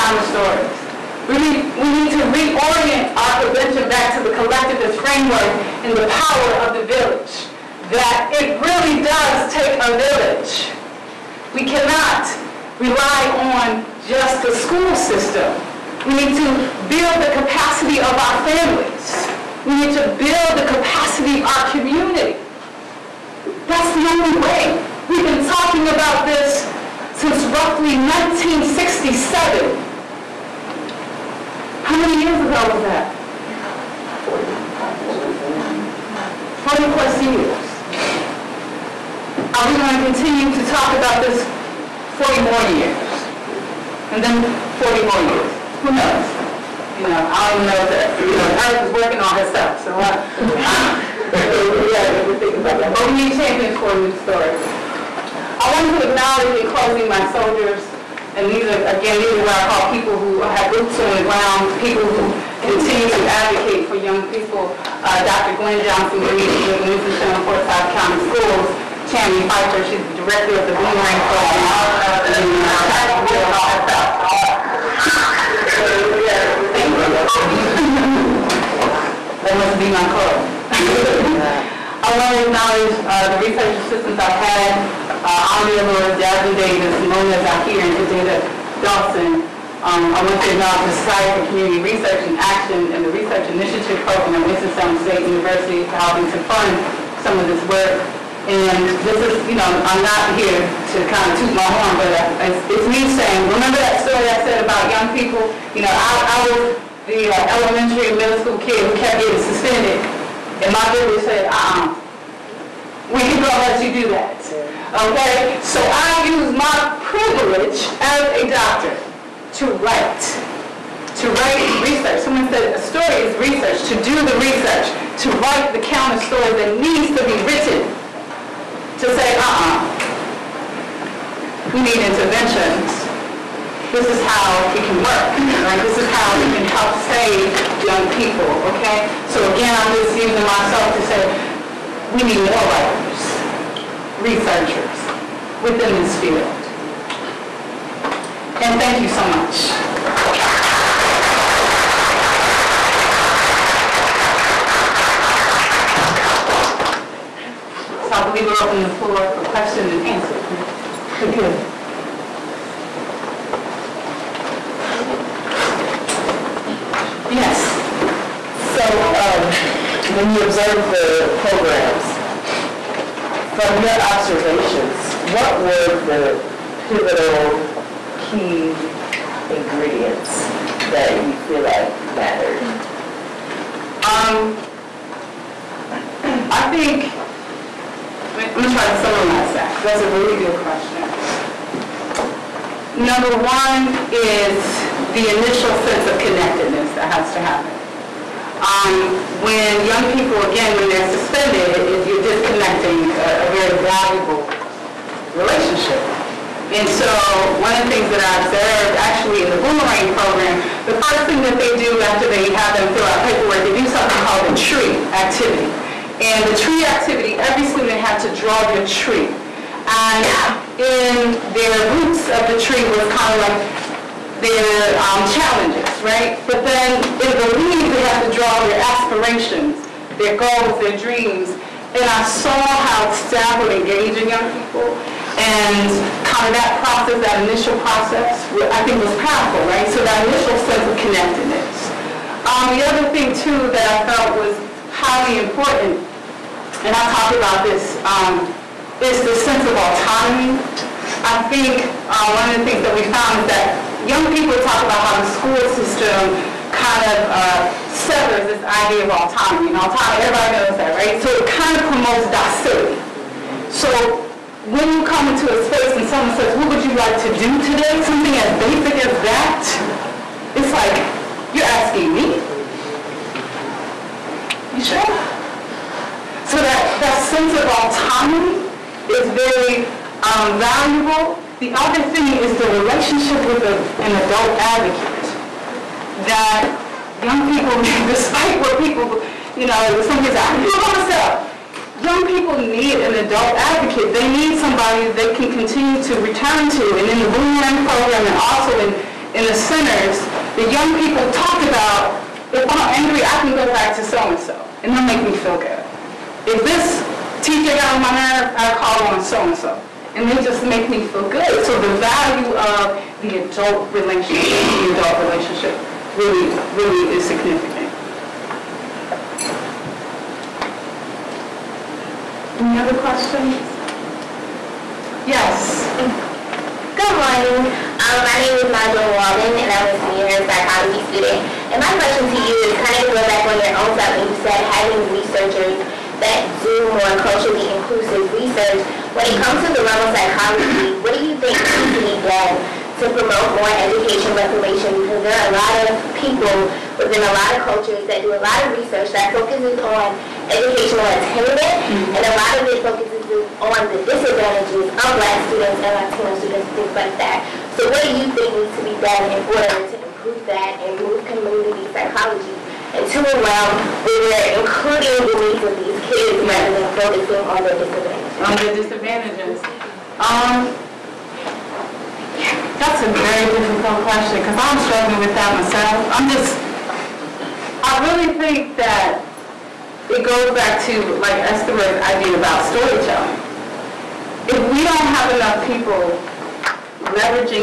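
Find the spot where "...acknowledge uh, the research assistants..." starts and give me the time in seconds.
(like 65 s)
82 s.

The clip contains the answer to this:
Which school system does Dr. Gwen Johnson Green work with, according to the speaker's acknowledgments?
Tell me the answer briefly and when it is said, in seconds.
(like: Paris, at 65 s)
Winston-Salem Forsyth County Schools, at 66 s.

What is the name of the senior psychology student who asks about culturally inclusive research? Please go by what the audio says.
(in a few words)
Nigel Walden.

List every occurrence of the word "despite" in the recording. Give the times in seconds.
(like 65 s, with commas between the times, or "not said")
288 s.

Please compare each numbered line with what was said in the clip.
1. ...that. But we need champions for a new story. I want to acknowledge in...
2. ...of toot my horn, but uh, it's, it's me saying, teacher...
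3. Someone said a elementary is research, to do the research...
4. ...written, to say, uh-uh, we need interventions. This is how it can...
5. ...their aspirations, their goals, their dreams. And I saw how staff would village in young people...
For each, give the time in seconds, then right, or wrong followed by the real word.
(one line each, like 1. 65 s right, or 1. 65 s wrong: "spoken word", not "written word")
1. 52 s right
2. 101 s wrong: "remember", not "teacher"
3. 122 s wrong: "story", not "elementary"
4. 127 s right
5. 228 s wrong: "engage", not "village".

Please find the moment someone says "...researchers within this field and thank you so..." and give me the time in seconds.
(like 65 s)
144 s.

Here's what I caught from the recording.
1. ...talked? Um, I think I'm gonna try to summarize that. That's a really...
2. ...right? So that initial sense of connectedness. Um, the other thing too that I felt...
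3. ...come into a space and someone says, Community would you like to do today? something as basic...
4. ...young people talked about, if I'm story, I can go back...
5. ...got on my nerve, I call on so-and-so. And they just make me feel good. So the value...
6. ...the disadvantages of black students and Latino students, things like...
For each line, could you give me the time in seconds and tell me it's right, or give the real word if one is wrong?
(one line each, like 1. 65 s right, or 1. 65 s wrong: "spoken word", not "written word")
1. 182 s wrong: "mattered", not "talked"
2. 239 s right
3. 265 s wrong: "What", not "Community"
4. 300 s wrong: "angry", not "story"
5. 307 s right
6. 353 s right.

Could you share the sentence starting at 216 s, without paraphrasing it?
And the tree activity, every student had to draw their tree.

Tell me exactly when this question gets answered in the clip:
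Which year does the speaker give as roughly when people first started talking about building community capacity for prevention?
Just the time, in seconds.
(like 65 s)
27 s.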